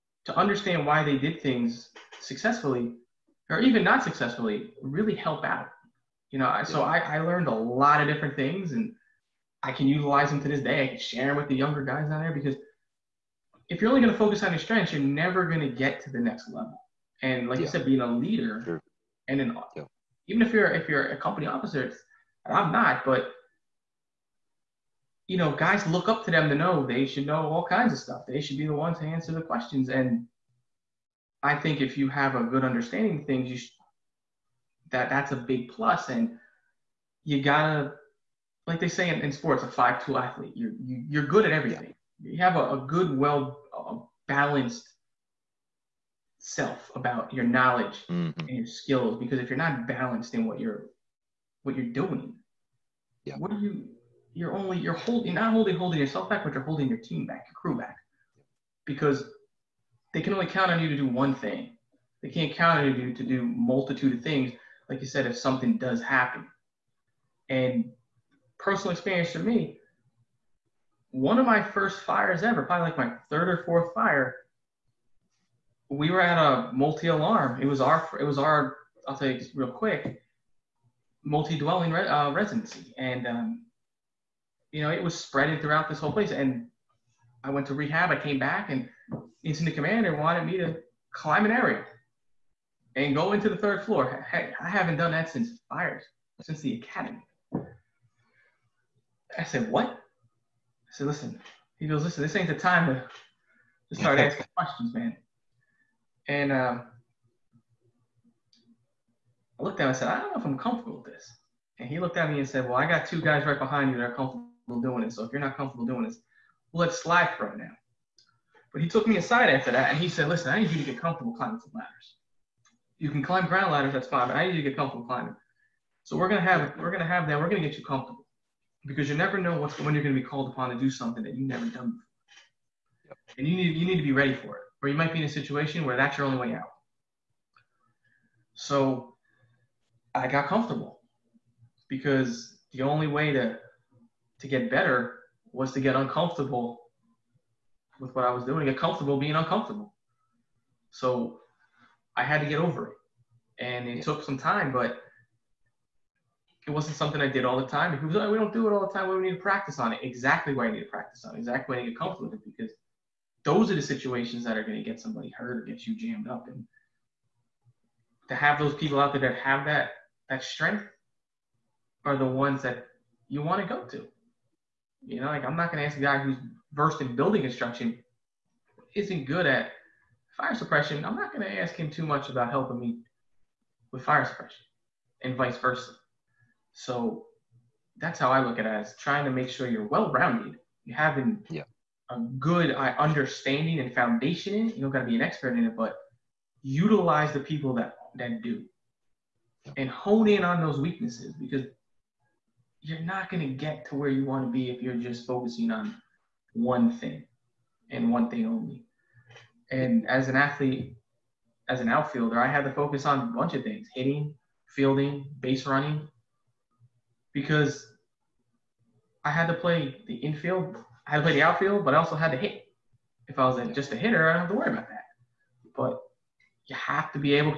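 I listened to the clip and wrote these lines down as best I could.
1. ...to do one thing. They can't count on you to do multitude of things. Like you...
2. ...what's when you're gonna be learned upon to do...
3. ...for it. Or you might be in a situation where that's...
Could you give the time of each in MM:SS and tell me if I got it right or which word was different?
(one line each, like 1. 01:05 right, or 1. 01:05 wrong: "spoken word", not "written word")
1. 01:00 right
2. 02:09 wrong: "called", not "learned"
3. 02:14 right.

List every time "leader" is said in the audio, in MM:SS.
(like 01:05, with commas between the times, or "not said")
00:18.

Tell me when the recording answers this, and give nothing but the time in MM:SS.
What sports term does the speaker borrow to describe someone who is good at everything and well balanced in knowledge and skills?
00:39.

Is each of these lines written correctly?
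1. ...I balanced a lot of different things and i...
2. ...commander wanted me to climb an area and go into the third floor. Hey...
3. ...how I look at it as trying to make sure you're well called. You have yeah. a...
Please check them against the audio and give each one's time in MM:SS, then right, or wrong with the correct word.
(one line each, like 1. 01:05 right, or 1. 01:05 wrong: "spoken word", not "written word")
1. 00:06 wrong: "learned", not "balanced"
2. 01:29 right
3. 03:08 wrong: "rounded", not "called".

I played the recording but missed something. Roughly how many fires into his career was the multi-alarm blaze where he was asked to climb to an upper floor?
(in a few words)
third or fourth.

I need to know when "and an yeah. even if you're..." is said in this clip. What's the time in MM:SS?
00:19.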